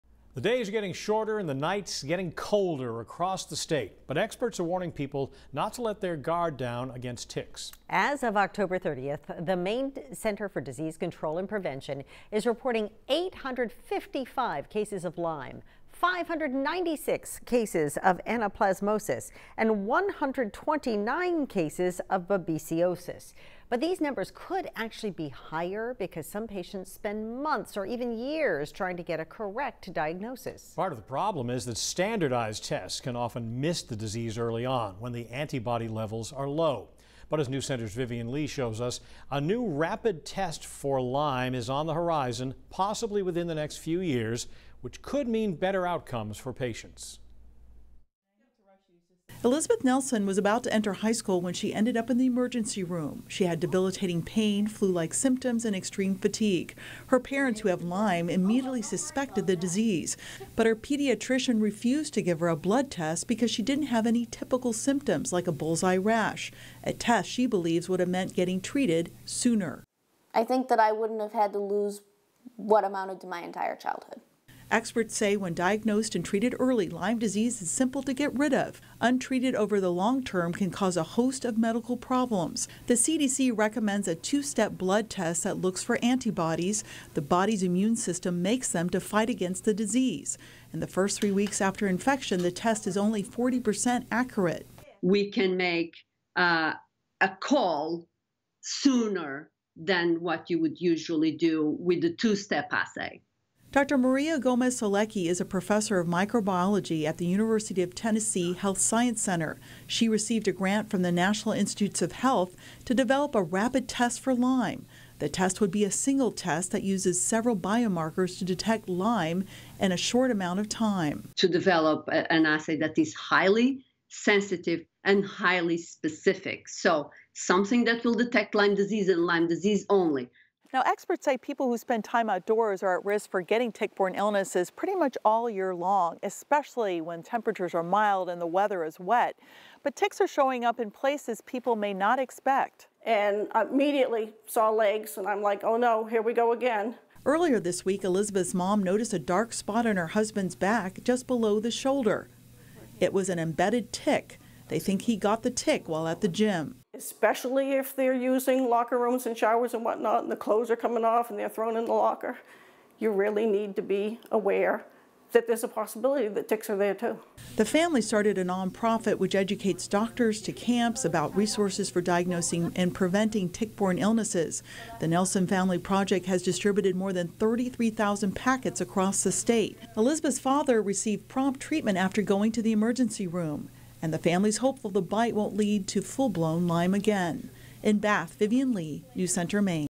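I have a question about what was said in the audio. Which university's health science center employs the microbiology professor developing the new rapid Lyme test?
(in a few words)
University of Tennessee.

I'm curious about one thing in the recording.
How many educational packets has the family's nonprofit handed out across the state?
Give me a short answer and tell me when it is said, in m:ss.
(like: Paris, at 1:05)
33,000, at 2:57.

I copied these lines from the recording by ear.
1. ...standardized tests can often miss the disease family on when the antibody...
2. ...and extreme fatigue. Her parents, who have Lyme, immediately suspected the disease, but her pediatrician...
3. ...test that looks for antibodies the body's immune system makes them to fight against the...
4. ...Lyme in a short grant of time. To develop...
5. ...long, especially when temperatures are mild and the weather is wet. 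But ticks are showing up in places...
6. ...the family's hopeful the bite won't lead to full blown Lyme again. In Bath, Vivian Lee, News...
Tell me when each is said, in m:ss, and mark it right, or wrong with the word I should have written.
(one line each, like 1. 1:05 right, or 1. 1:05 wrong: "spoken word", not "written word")
1. 0:31 wrong: "early", not "family"
2. 0:55 right
3. 1:25 right
4. 1:58 wrong: "amount", not "grant"
5. 2:15 right
6. 3:04 right.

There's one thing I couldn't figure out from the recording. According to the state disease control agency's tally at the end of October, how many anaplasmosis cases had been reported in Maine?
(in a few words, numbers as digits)
596.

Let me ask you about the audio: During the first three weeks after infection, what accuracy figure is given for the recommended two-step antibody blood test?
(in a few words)
40%.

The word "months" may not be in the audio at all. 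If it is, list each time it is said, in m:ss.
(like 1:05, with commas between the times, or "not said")
0:27.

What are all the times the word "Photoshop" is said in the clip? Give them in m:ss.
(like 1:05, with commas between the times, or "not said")
not said.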